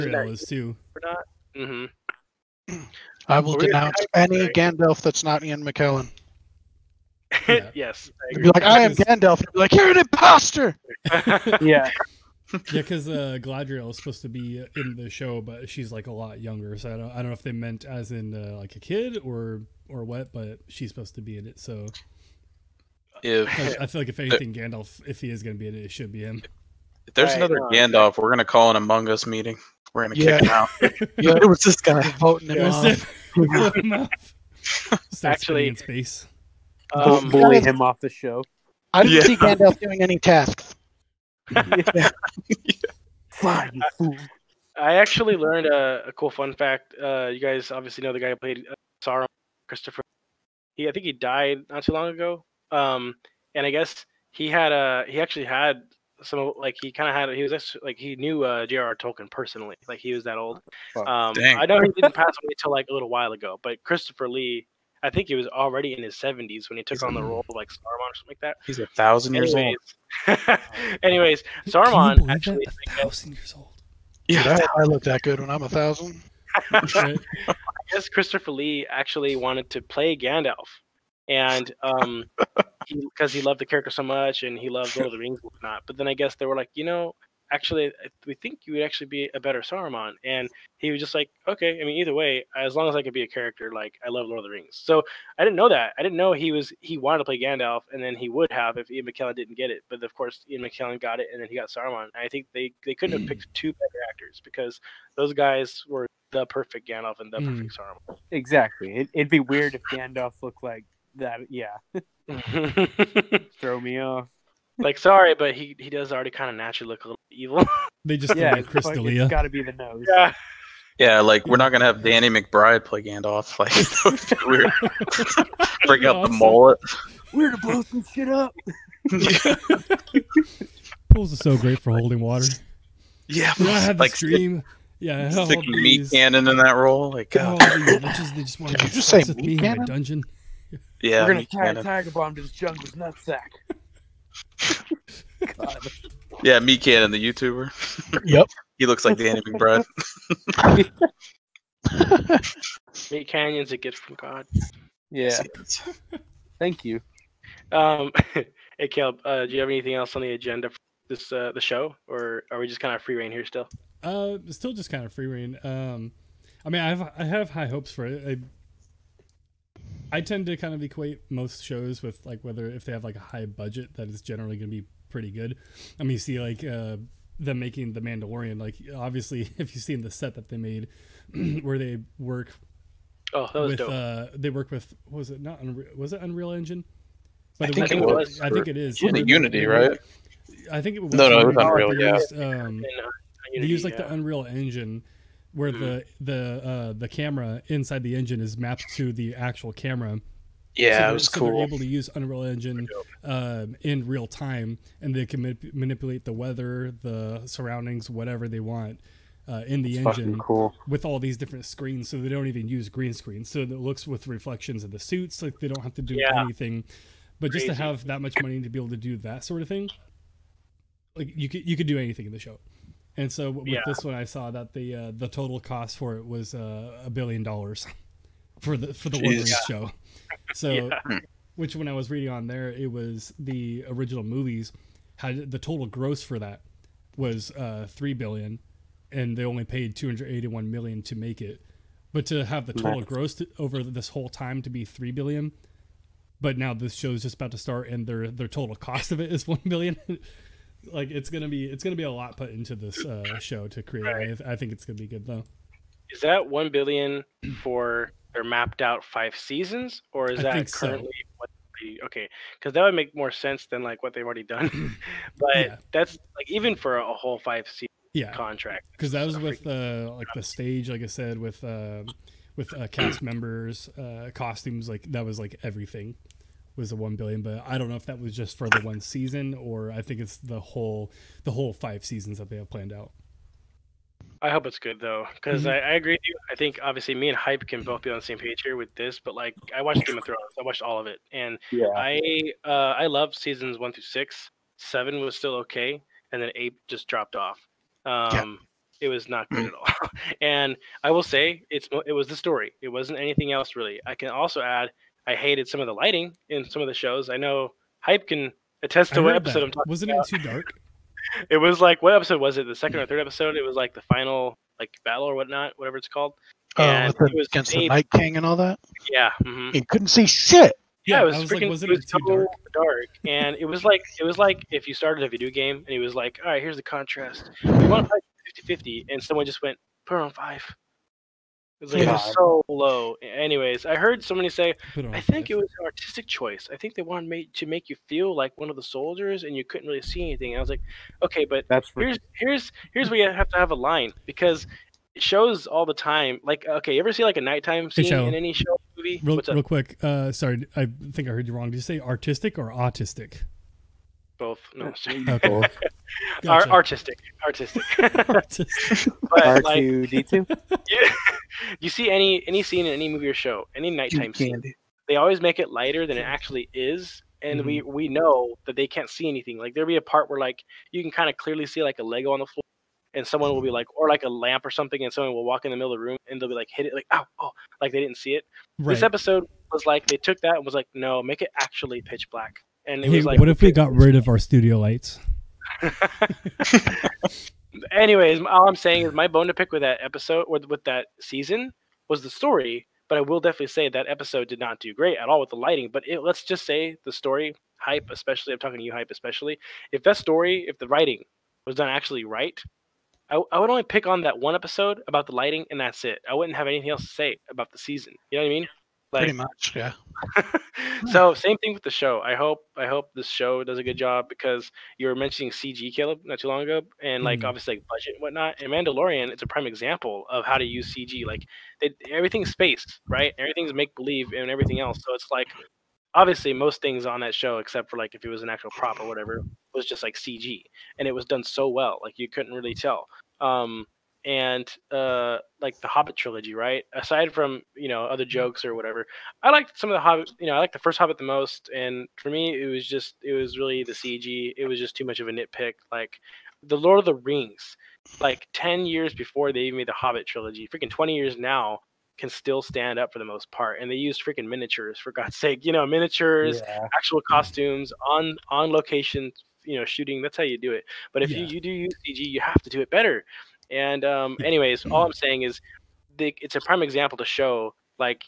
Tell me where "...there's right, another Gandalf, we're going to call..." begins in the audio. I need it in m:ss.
0:27.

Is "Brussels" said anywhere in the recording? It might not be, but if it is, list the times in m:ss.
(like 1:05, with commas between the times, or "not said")
not said.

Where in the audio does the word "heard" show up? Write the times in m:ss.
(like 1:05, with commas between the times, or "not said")
5:33, 5:51.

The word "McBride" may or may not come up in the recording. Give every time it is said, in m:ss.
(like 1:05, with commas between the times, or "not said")
2:02, 2:29.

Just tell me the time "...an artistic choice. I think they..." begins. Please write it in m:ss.
5:35.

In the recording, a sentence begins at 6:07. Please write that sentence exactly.
we we know that they can't see anything.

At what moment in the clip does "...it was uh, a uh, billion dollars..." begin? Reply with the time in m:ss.
3:46.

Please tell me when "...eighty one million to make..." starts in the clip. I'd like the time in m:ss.
4:00.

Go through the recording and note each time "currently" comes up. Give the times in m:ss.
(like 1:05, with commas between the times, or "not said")
4:20.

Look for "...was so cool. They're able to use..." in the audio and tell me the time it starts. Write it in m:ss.
3:21.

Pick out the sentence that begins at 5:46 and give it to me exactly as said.
Like, uh, okay, you ever see like a nighttime scene hey, in any show movie?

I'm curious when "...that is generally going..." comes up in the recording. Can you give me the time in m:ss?
2:53.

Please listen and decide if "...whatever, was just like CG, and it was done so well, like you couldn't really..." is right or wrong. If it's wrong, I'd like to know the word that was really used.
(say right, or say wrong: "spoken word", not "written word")
right.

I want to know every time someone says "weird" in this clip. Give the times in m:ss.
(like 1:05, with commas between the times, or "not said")
1:49, 2:04.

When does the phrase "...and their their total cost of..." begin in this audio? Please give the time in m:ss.
4:07.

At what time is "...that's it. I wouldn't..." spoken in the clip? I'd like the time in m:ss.
6:45.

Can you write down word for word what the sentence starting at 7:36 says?
actual costumes on on location you know shooting that's how you do it but if yeah.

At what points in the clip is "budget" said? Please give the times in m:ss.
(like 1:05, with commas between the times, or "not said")
2:53, 6:57.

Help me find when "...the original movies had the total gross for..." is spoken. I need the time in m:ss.
3:53.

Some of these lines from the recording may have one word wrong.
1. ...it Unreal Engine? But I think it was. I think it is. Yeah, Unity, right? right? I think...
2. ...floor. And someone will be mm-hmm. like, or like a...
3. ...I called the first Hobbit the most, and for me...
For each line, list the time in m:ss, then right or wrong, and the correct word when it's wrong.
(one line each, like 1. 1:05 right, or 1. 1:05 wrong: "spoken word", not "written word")
1. 3:06 right
2. 6:12 right
3. 7:20 wrong: "liked", not "called".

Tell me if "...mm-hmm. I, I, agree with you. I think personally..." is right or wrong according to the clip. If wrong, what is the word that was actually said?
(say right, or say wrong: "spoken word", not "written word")
wrong: "obviously", not "personally".